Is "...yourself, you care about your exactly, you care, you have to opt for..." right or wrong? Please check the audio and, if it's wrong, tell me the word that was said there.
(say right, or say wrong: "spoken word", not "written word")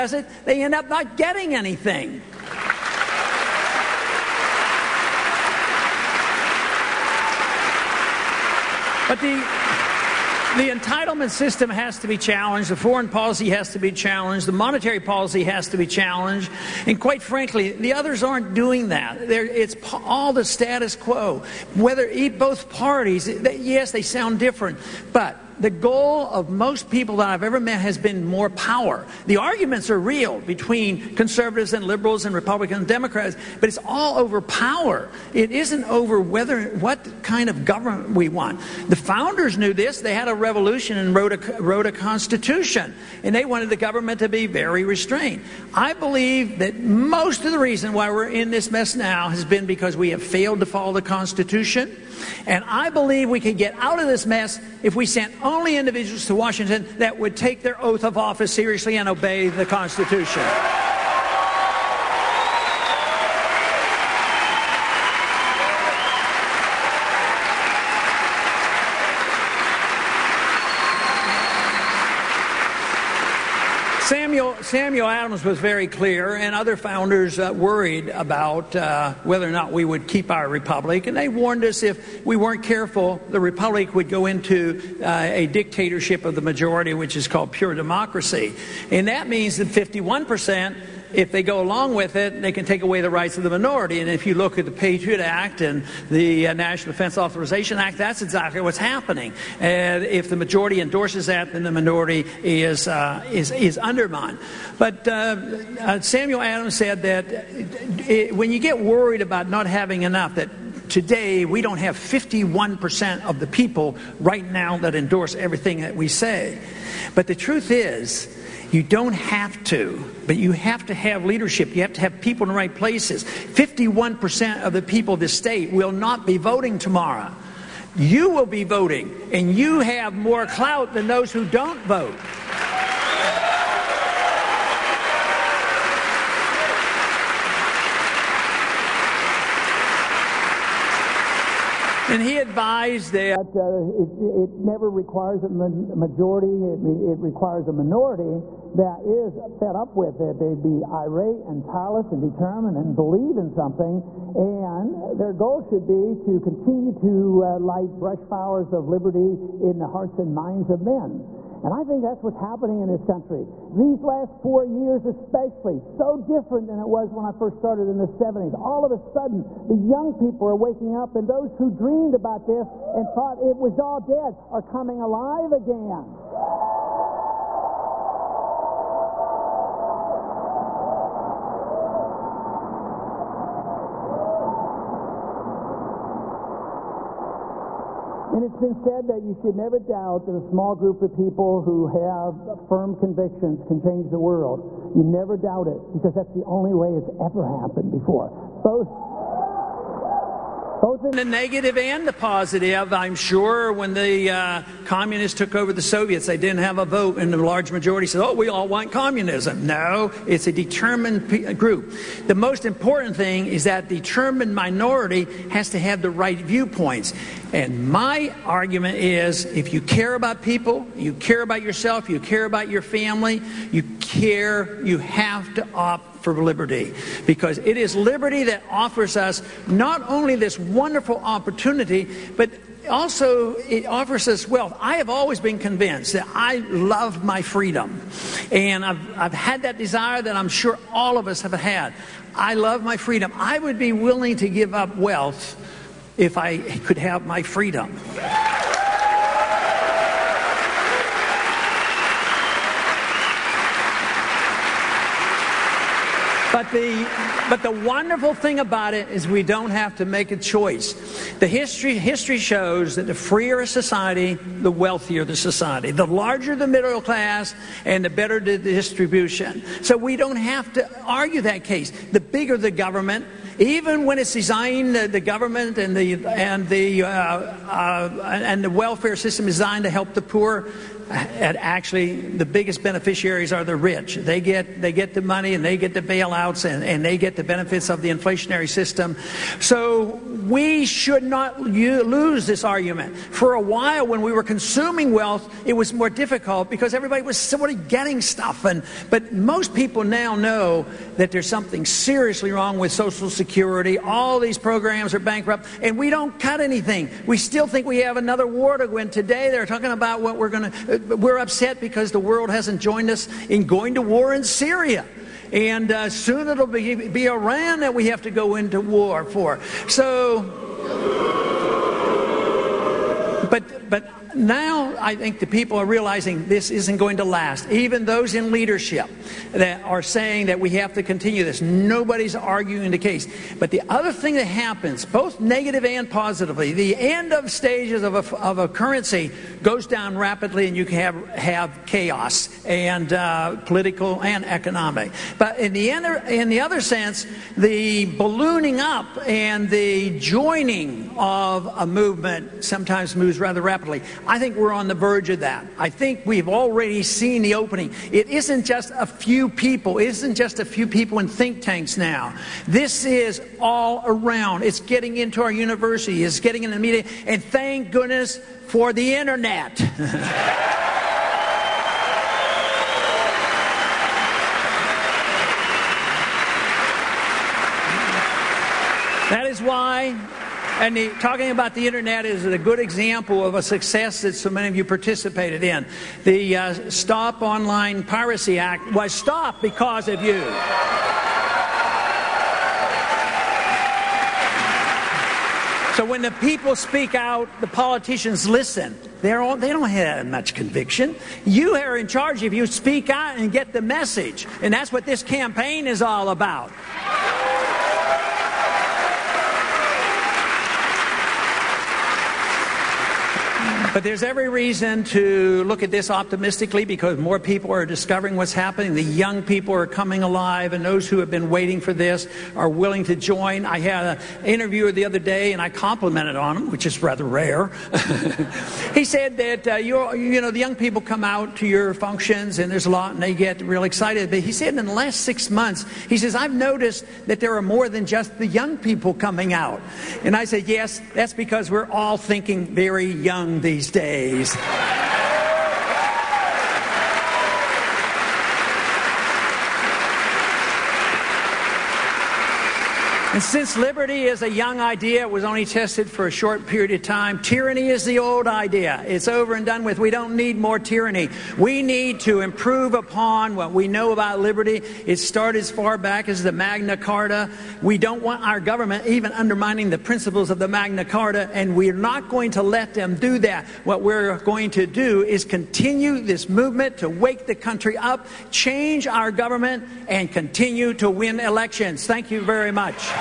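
wrong: "family", not "exactly".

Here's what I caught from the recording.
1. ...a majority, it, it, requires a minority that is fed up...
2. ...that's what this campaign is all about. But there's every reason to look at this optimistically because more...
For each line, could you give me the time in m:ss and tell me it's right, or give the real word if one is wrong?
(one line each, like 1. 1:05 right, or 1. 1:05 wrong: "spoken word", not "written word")
1. 2:25 right
2. 6:44 right.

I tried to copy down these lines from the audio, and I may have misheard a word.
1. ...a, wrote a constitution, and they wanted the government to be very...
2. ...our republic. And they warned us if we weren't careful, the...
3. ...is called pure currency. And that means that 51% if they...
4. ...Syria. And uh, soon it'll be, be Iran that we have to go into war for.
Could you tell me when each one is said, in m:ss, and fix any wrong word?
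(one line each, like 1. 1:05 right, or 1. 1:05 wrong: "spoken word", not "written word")
1. 0:41 right
2. 1:20 right
3. 1:27 wrong: "democracy", not "currency"
4. 5:14 right.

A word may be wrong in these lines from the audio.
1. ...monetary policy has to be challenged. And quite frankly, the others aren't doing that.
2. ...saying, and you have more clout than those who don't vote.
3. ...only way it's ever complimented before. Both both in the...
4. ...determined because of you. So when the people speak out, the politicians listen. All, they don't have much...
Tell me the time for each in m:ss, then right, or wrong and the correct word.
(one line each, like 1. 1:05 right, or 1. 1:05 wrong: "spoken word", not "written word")
1. 0:14 right
2. 2:08 wrong: "voting", not "saying"
3. 3:16 wrong: "happened", not "complimented"
4. 6:29 wrong: "stopped", not "determined".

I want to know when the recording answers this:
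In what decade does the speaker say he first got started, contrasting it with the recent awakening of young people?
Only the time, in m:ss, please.
2:47.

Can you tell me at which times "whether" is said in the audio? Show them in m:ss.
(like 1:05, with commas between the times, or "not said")
0:21, 0:36, 1:19.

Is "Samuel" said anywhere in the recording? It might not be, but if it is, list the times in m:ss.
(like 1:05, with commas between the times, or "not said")
1:14, 1:46.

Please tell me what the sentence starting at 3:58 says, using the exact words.
And I've, I've had that desire that I'm sure all of us have had.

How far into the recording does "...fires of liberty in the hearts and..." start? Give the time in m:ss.
2:38.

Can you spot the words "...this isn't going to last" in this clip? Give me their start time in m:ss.
5:26.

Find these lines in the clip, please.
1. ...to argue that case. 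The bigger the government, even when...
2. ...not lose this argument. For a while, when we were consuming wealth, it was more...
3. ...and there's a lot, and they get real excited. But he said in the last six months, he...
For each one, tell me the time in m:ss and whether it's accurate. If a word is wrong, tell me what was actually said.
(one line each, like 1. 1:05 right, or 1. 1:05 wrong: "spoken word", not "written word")
1. 4:30 right
2. 4:51 right
3. 7:12 right.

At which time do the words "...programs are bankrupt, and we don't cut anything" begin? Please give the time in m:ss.
5:04.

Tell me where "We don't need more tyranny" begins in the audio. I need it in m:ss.
7:39.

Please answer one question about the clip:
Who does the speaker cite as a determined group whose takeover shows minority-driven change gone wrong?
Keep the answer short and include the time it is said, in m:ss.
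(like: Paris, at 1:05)
Soviets, at 3:25.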